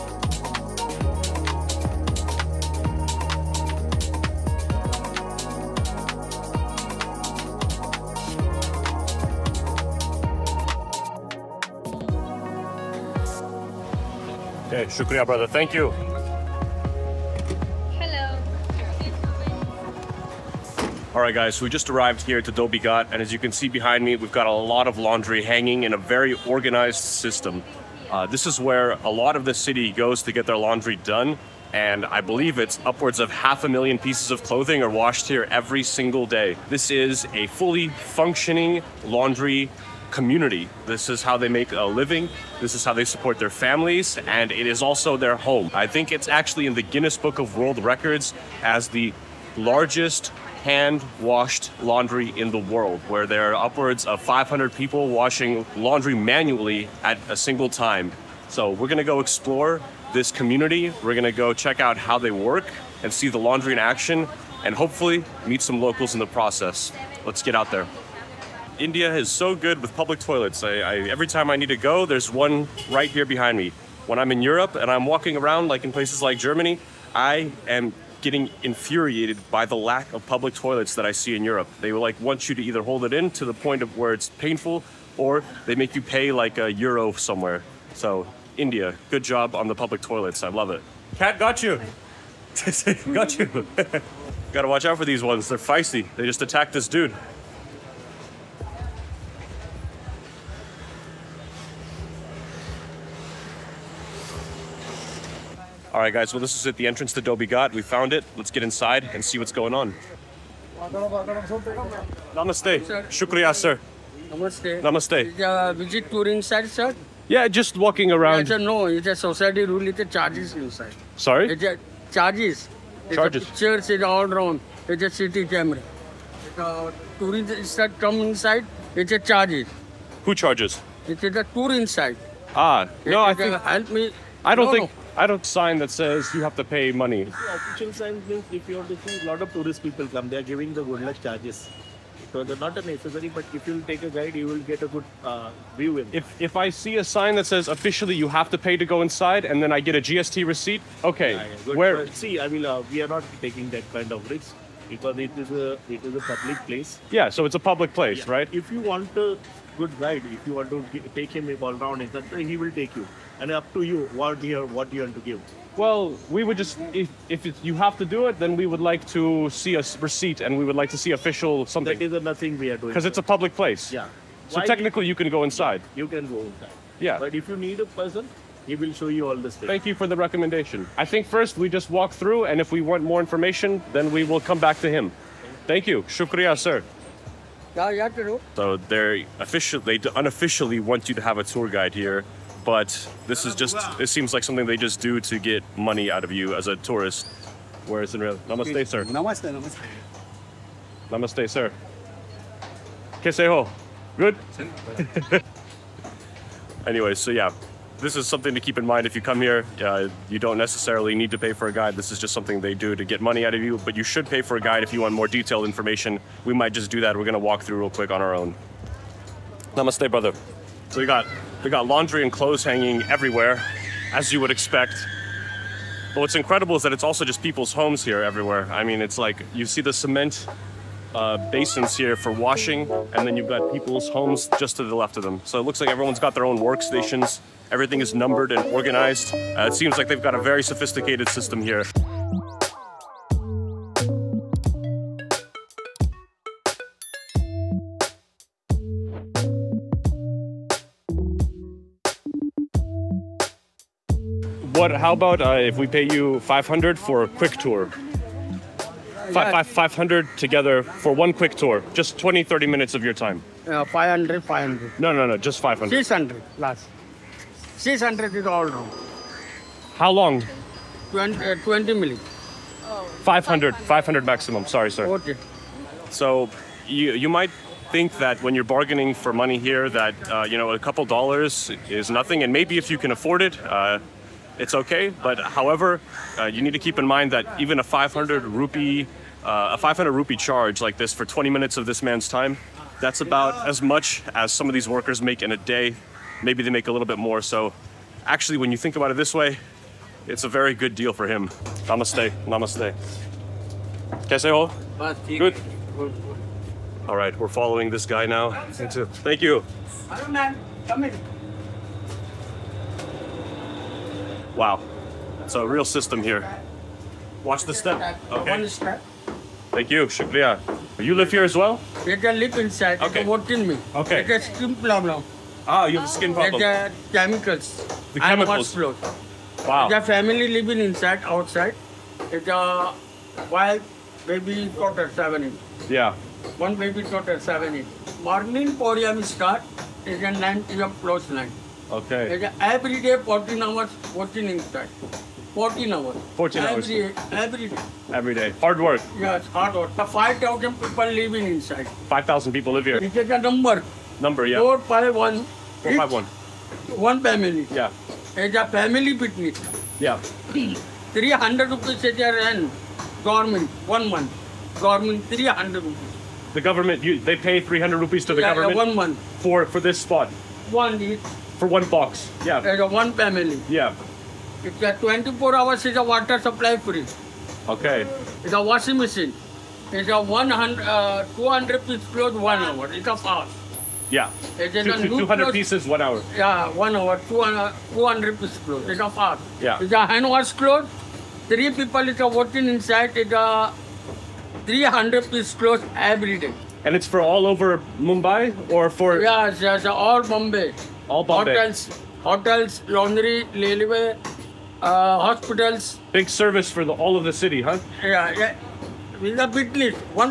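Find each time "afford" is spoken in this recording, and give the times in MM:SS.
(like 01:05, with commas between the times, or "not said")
04:43.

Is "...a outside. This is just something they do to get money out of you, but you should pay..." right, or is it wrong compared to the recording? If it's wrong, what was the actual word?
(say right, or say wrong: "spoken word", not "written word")
wrong: "guide", not "outside".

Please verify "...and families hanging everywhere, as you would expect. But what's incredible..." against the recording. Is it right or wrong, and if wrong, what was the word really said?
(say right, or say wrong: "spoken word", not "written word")
wrong: "clothes", not "families".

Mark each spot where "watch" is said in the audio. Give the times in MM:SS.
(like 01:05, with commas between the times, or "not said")
01:34, 05:17.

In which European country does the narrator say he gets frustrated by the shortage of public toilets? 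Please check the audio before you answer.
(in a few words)
Germany.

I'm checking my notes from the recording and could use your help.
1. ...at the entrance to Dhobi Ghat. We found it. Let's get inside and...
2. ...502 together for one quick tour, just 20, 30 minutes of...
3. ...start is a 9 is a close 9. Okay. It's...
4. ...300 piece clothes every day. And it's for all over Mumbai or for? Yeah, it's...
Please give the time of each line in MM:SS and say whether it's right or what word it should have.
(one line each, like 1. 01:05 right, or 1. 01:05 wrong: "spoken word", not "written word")
1. 01:46 right
2. 04:19 wrong: "500", not "502"
3. 05:39 right
4. 06:34 right.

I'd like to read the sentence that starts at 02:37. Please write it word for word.
Yeah, so it's a public place, yeah.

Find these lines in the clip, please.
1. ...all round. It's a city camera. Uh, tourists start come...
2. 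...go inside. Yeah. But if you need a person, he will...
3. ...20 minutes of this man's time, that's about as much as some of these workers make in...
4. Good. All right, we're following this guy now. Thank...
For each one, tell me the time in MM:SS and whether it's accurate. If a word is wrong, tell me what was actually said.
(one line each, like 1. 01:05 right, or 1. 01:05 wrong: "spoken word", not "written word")
1. 02:04 right
2. 02:56 right
3. 04:51 right
4. 05:05 right.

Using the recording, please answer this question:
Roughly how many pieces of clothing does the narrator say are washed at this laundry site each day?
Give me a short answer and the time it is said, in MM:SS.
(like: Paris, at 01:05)
half a million, at 00:33.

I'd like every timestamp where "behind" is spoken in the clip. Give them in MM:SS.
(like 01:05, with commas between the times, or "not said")
00:23, 01:13.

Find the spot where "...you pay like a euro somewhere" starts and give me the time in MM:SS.
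01:25.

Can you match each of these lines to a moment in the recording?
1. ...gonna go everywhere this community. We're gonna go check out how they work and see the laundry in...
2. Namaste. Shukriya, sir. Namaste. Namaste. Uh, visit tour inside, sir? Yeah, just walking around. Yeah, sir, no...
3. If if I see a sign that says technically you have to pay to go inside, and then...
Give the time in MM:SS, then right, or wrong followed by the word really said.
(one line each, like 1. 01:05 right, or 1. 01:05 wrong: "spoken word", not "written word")
1. 00:58 wrong: "explore", not "everywhere"
2. 01:52 right
3. 02:26 wrong: "officially", not "technically".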